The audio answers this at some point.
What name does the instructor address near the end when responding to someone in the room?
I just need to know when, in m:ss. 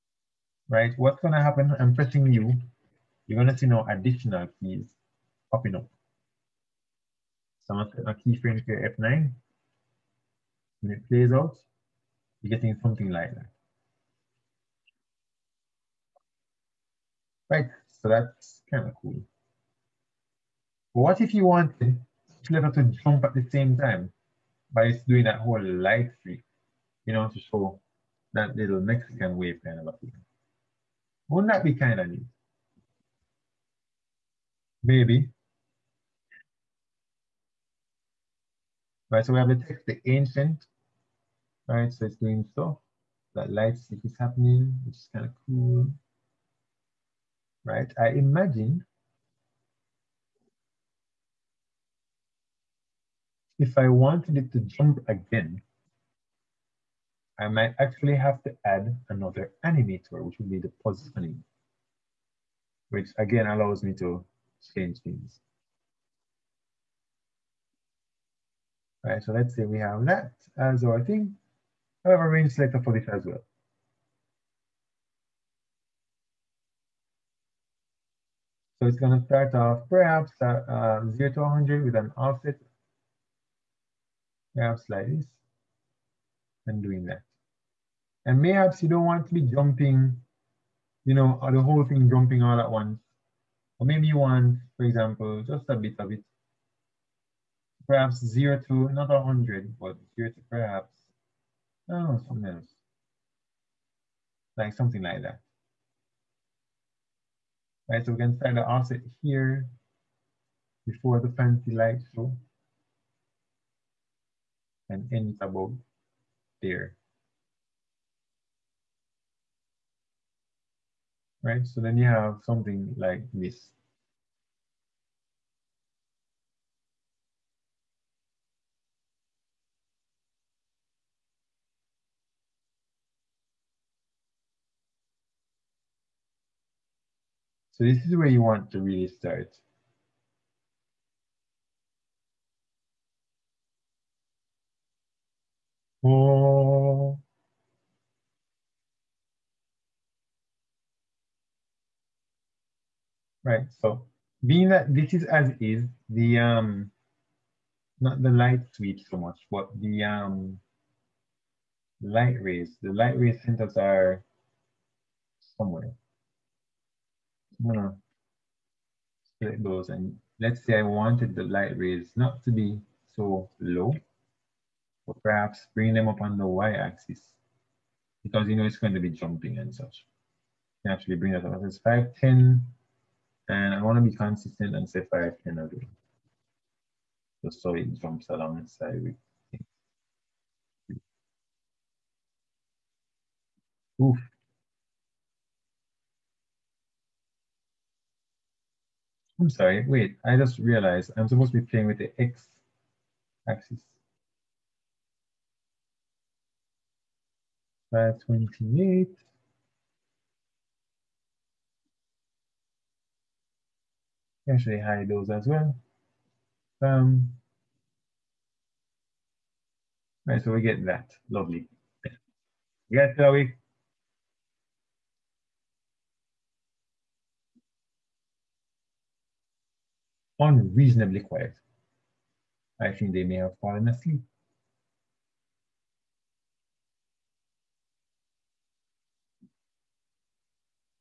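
3:43.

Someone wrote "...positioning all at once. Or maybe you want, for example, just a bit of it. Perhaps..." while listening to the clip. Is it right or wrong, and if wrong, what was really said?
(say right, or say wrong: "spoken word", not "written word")
wrong: "jumping", not "positioning".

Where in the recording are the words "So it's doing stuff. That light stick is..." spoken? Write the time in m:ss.
0:41.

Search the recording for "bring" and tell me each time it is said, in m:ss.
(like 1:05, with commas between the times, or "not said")
2:55, 3:01.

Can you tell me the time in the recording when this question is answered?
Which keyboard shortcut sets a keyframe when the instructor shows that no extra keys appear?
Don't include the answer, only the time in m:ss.
0:08.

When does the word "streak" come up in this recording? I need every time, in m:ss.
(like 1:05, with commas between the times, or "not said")
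0:26.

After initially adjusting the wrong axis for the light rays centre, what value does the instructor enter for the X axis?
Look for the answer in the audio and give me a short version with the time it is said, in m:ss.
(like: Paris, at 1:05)
528, at 3:27.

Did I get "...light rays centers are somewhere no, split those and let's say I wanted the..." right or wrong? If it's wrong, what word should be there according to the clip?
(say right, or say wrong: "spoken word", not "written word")
right.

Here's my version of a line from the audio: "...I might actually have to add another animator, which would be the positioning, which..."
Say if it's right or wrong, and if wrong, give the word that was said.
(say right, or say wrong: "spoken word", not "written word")
right.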